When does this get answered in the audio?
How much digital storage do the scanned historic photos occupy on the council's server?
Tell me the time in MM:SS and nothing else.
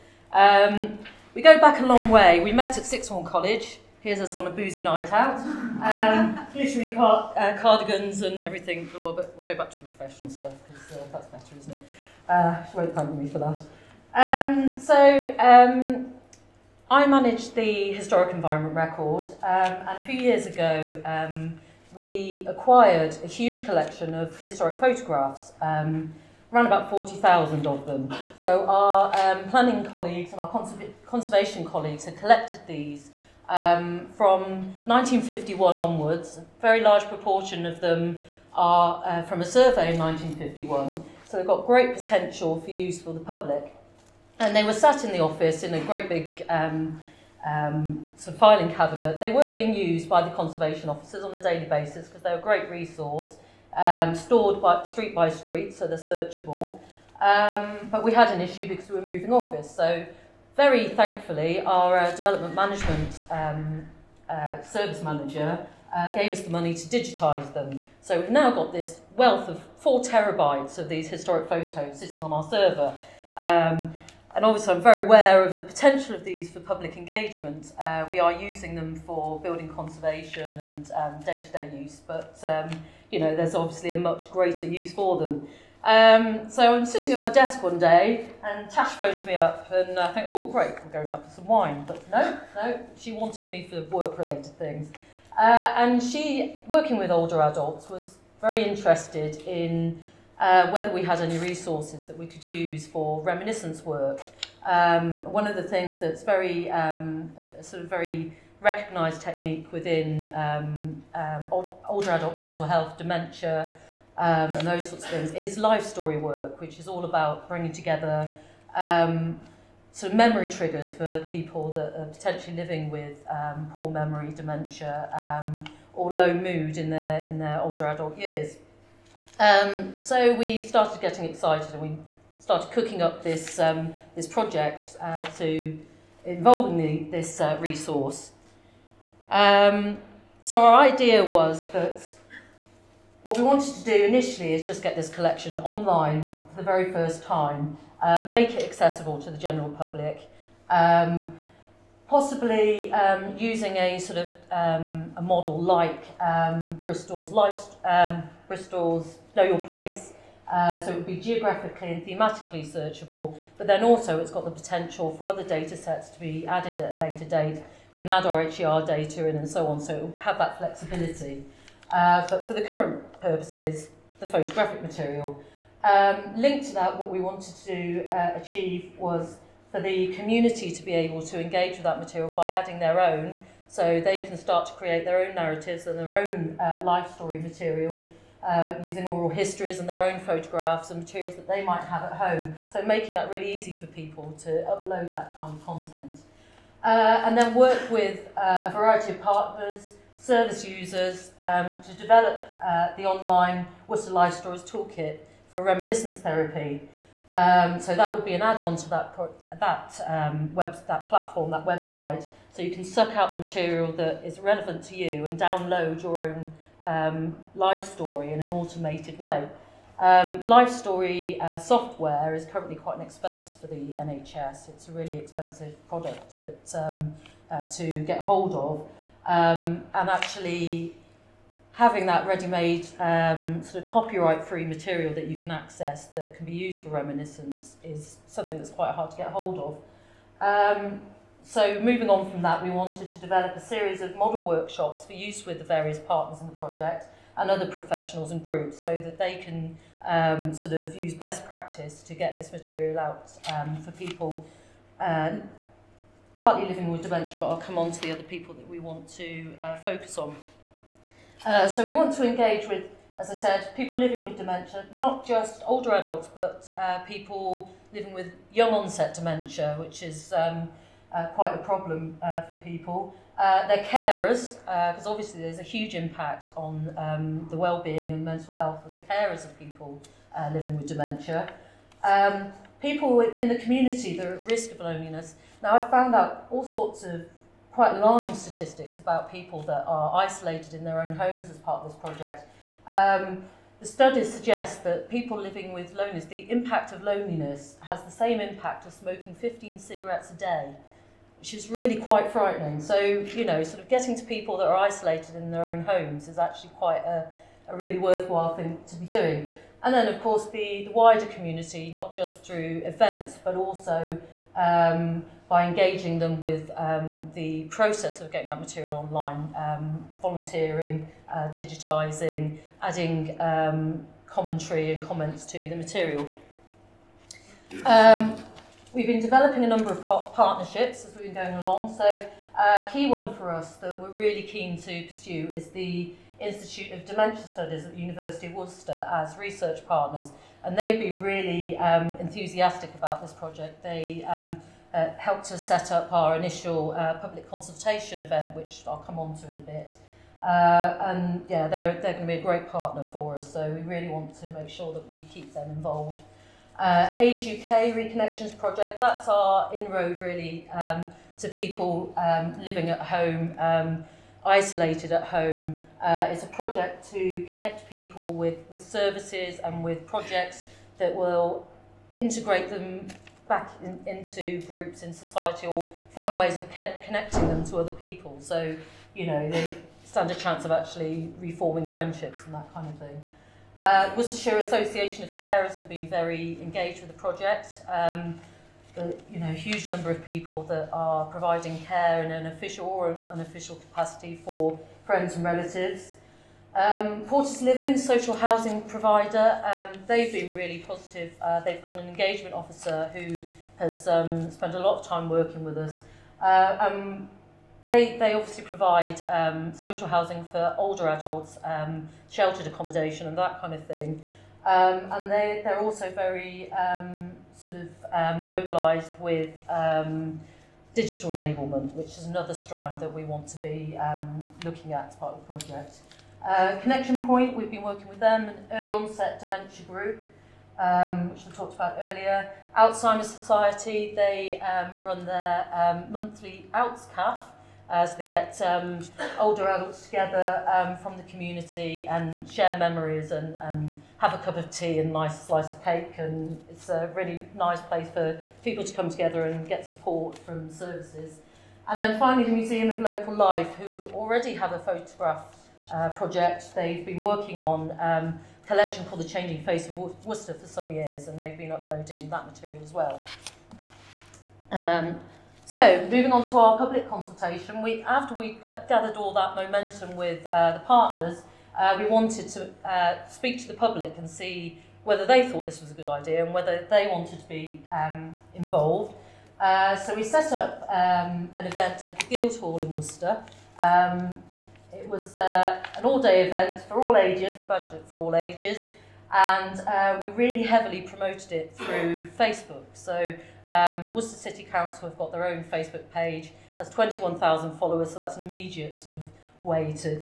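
01:09.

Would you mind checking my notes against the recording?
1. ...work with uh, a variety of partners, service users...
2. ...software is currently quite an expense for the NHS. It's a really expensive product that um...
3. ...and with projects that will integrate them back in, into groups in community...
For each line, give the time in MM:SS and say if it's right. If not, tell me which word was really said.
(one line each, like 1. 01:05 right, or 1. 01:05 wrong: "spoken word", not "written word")
1. 03:17 right
2. 03:41 right
3. 06:09 wrong: "society", not "community".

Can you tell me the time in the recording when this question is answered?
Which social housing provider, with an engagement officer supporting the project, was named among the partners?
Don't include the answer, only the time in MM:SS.
06:37.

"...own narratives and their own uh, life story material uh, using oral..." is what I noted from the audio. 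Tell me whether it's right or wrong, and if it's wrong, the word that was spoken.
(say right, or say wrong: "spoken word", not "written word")
right.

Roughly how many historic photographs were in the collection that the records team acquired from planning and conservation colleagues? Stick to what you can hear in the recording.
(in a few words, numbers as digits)
40,000.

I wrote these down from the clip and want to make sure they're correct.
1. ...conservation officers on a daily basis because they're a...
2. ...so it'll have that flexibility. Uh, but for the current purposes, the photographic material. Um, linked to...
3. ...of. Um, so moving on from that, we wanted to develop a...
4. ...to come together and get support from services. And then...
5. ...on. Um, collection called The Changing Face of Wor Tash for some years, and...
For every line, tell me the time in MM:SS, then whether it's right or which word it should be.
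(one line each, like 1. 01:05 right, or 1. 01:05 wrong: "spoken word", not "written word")
1. 00:50 right
2. 02:49 right
3. 03:59 right
4. 07:28 right
5. 07:37 wrong: "Worcester", not "Tash".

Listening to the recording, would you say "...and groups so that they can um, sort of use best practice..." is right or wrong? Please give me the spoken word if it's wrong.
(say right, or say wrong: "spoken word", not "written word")
right.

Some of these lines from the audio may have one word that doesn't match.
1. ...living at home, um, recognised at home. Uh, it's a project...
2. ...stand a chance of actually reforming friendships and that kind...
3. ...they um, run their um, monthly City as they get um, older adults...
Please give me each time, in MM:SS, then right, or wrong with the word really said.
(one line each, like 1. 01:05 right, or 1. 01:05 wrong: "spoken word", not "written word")
1. 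06:02 wrong: "isolated", not "recognised"
2. 06:20 right
3. 07:14 wrong: "ALTS", not "City".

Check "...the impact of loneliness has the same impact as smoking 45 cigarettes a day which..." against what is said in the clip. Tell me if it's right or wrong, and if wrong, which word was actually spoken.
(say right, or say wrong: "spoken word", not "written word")
wrong: "15", not "45".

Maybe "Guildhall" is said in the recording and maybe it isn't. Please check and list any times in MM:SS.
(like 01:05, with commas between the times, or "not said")
08:02.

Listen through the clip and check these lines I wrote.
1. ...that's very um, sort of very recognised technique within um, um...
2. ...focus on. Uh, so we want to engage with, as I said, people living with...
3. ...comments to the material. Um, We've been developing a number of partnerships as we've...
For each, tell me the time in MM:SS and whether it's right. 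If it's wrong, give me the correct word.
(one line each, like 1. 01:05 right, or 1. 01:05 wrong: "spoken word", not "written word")
1. 01:46 right
2. 04:19 right
3. 05:25 right.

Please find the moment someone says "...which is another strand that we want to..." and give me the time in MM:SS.
07:01.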